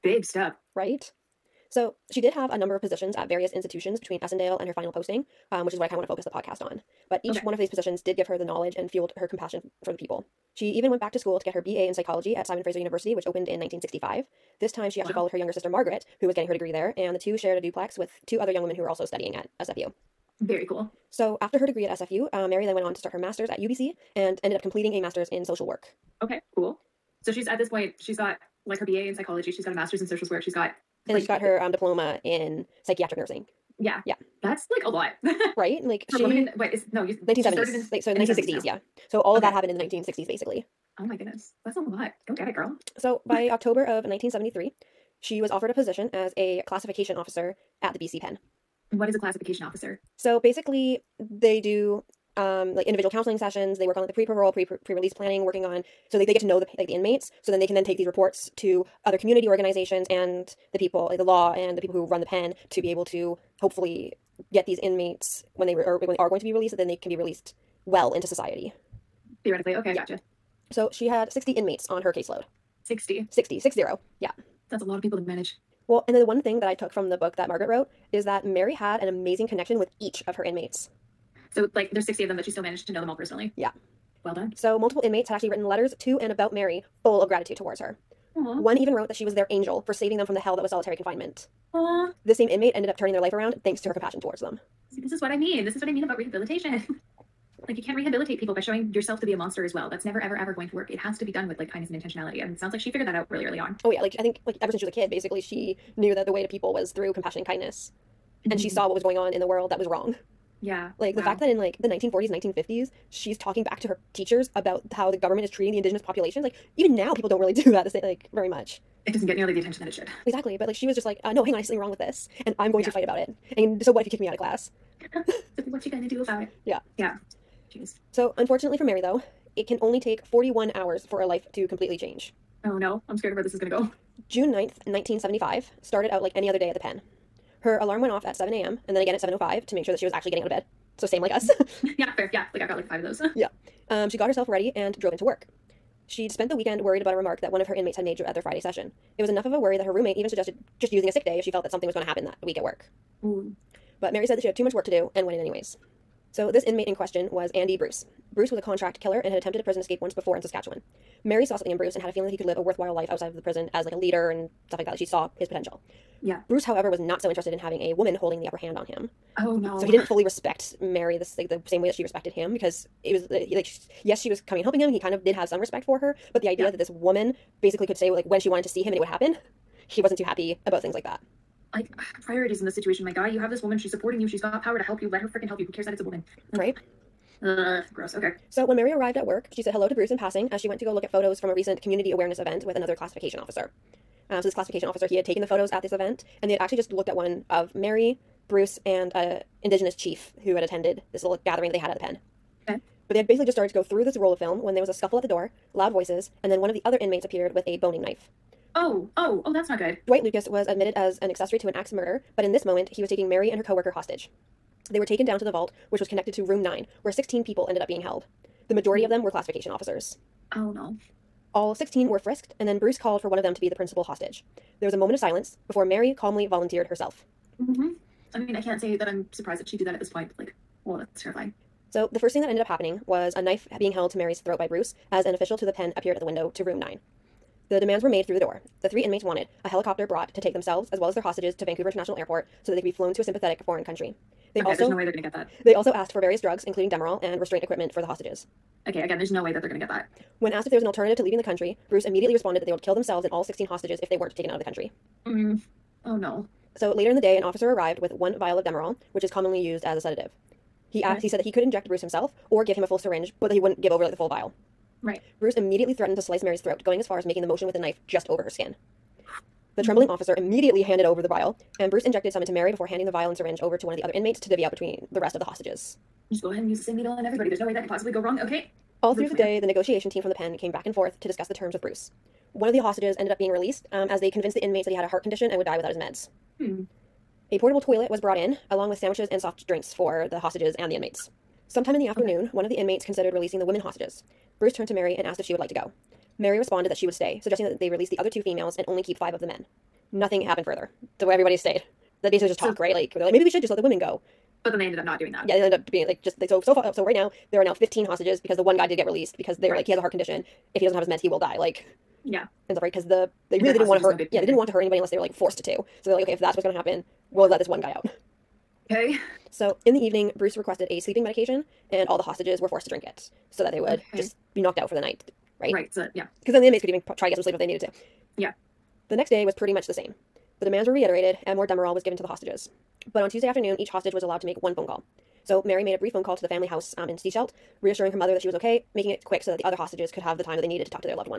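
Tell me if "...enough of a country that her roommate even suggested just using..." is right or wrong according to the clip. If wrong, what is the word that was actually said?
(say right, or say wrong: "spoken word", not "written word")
wrong: "worry", not "country".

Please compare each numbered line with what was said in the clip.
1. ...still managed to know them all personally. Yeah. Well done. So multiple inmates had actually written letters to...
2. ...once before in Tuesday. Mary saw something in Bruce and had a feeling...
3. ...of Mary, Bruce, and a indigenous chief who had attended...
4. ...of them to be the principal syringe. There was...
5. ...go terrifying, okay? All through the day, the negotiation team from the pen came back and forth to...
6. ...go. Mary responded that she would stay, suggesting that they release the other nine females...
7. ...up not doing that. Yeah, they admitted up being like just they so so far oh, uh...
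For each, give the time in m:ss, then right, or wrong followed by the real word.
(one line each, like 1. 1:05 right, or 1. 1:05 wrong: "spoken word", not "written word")
1. 1:22 right
2. 2:40 wrong: "Saskatchewan", not "Tuesday"
3. 3:17 right
4. 3:43 wrong: "hostage", not "syringe"
5. 4:38 wrong: "wrong", not "terrifying"
6. 4:55 wrong: "two", not "nine"
7. 5:04 wrong: "ended", not "admitted".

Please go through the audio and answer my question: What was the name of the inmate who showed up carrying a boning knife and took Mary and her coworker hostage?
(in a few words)
Dwight Lucas.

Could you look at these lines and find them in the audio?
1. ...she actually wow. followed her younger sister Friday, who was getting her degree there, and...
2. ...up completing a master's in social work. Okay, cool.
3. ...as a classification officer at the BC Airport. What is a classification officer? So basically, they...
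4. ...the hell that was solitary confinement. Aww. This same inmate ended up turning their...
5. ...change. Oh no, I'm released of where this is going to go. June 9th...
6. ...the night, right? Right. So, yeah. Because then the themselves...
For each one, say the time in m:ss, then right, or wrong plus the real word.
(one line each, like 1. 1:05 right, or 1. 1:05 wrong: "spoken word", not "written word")
1. 0:14 wrong: "Margaret", not "Friday"
2. 0:24 right
3. 0:46 wrong: "Pen", not "Airport"
4. 1:30 right
5. 2:11 wrong: "scared", not "released"
6. 5:24 wrong: "inmates", not "themselves".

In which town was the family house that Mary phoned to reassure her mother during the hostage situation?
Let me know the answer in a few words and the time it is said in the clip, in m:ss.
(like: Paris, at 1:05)
Sechelt, at 5:37.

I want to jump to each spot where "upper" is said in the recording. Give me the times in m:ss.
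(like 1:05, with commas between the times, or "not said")
2:48.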